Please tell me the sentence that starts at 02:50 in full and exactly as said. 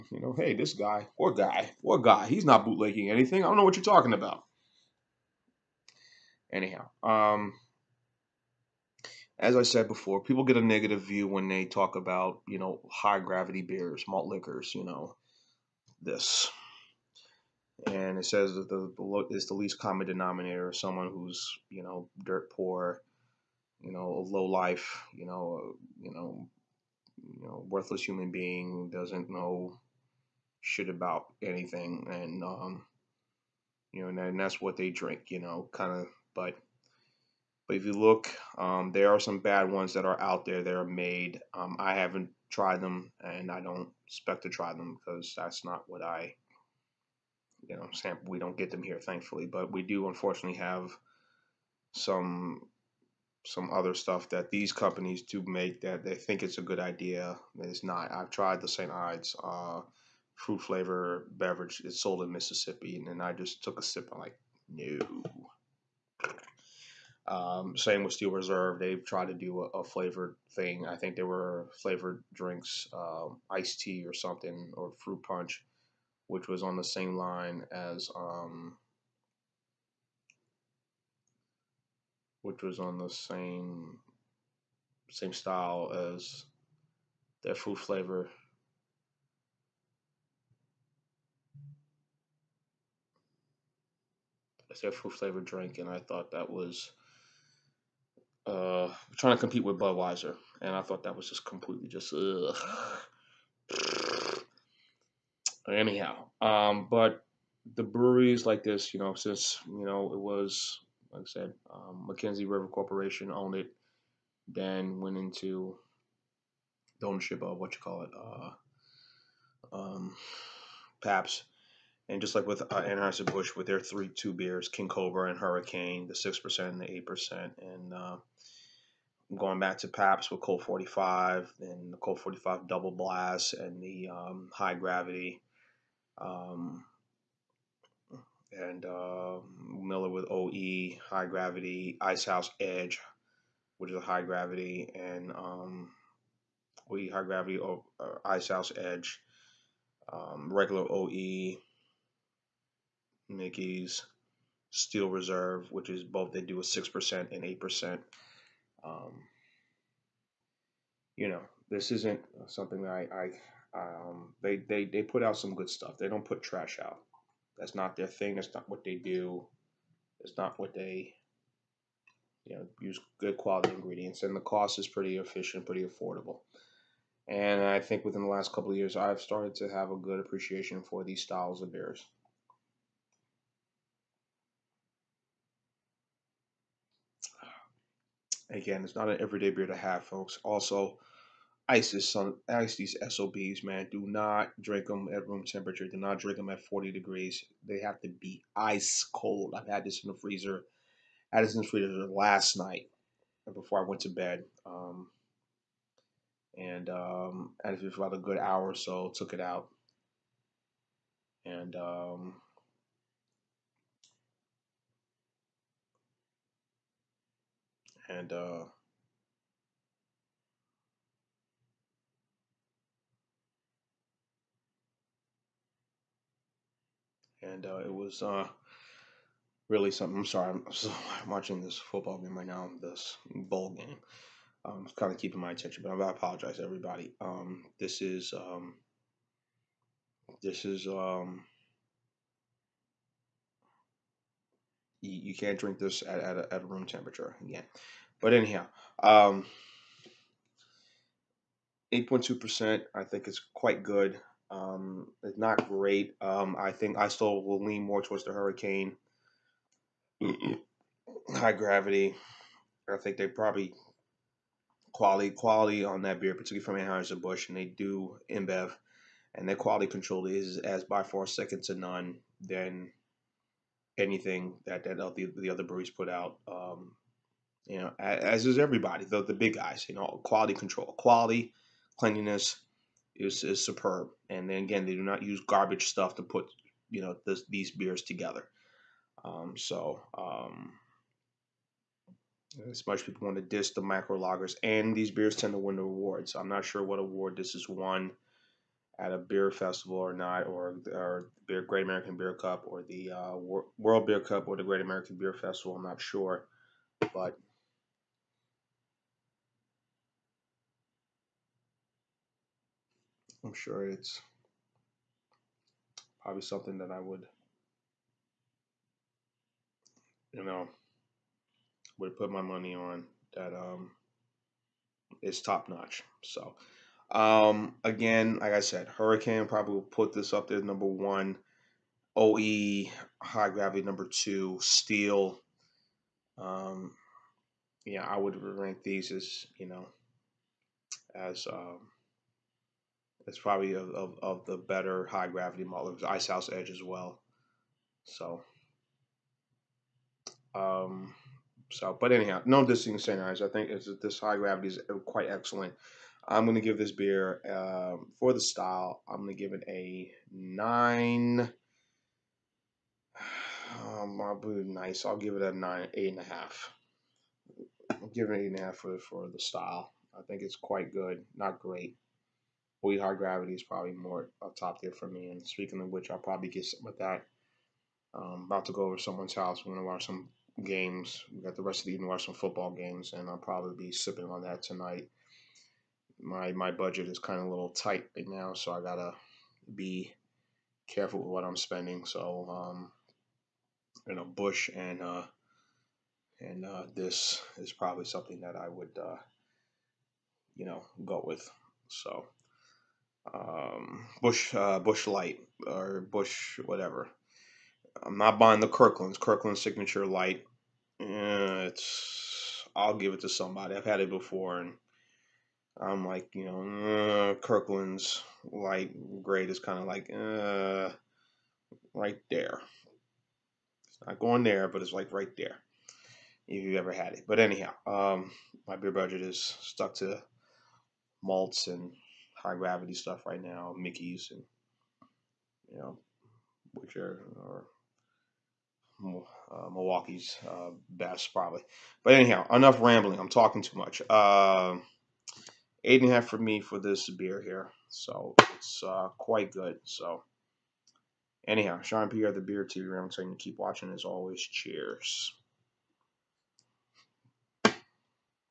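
It's not what they, you know, use good quality ingredients.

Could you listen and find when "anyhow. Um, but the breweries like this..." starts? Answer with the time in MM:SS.
01:45.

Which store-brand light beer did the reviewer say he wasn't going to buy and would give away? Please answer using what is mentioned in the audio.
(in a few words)
Kirkland Signature Light.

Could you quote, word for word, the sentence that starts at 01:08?
They've tried to do a, a flavored thing.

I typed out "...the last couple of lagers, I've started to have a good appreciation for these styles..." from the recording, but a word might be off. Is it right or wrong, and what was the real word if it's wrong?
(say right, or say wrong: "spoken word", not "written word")
wrong: "years", not "lagers".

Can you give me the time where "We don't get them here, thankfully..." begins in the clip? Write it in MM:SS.
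00:48.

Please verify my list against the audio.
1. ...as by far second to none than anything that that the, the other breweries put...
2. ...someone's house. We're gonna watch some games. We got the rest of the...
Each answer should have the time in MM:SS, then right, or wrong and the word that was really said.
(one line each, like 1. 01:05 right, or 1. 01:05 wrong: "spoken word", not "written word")
1. 04:30 right
2. 06:18 right.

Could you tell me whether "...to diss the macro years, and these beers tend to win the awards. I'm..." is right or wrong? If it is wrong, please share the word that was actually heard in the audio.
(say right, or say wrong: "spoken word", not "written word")
wrong: "lagers", not "years".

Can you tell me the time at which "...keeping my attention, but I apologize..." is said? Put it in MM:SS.
03:55.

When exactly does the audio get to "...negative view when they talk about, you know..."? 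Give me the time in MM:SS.
00:10.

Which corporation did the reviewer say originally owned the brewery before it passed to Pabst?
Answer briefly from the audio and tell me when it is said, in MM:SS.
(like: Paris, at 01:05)
McKenzie River Corporation, at 01:52.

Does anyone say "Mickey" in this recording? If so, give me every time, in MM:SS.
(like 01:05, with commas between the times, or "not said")
02:33, 07:13.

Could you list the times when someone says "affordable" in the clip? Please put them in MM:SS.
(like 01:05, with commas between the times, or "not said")
02:55.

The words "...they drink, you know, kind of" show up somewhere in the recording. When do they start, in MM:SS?
00:34.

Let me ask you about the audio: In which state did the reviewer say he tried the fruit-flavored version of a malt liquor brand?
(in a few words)
Mississippi.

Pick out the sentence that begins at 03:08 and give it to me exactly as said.
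Again, it's not an everyday beer to have, folks.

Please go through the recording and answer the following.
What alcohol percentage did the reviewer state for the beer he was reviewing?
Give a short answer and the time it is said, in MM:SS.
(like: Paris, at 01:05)
8.2%, at 04:11.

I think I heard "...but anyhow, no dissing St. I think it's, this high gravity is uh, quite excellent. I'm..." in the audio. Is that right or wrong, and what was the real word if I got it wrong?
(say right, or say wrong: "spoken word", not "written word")
right.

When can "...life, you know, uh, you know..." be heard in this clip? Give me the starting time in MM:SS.
00:24.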